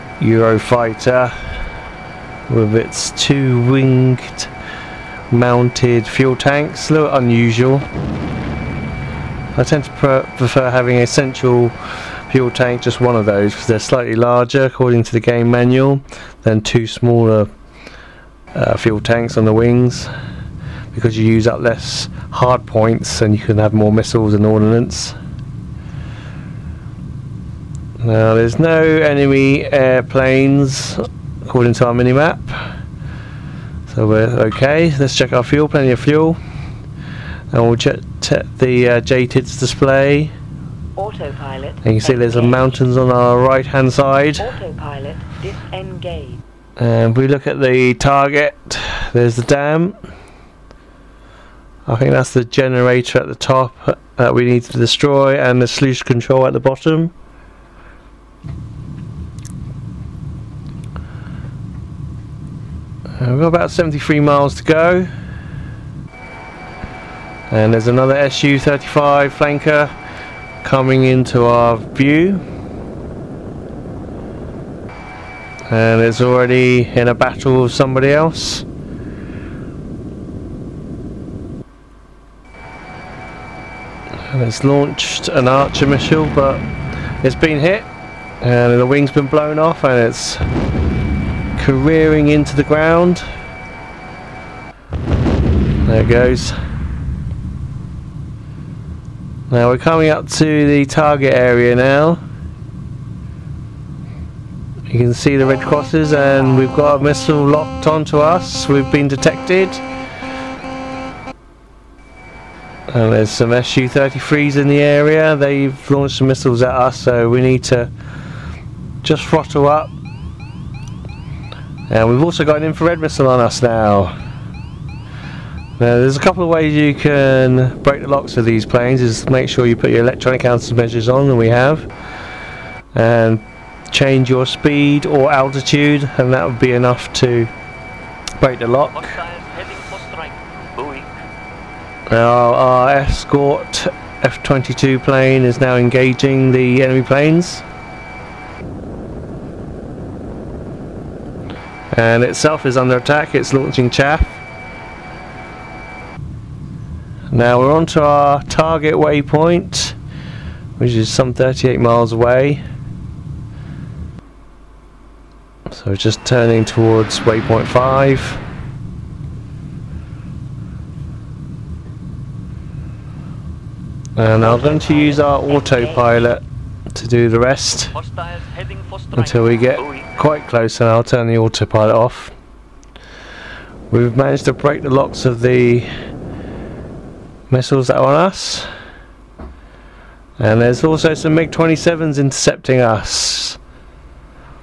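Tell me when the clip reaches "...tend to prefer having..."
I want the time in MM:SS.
00:09.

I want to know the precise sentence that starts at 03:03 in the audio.
We've managed to break the locks of the missiles that are on us.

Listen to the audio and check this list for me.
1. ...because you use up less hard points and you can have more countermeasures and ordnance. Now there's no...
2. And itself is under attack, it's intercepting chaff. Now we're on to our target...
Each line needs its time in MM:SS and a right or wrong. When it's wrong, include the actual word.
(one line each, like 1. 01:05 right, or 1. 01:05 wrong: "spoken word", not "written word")
1. 00:21 wrong: "missiles", not "countermeasures"
2. 02:31 wrong: "launching", not "intercepting".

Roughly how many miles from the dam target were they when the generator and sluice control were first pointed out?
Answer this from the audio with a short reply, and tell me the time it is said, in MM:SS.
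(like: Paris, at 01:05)
73, at 01:03.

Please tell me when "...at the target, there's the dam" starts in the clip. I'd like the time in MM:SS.
00:47.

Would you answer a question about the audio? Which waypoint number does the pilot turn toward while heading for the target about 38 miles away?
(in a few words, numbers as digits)
5.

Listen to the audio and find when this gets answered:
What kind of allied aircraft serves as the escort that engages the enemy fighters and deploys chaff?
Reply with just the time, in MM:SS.
02:24.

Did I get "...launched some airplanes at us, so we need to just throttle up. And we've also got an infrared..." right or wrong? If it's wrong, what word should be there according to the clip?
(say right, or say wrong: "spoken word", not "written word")
wrong: "missiles", not "airplanes".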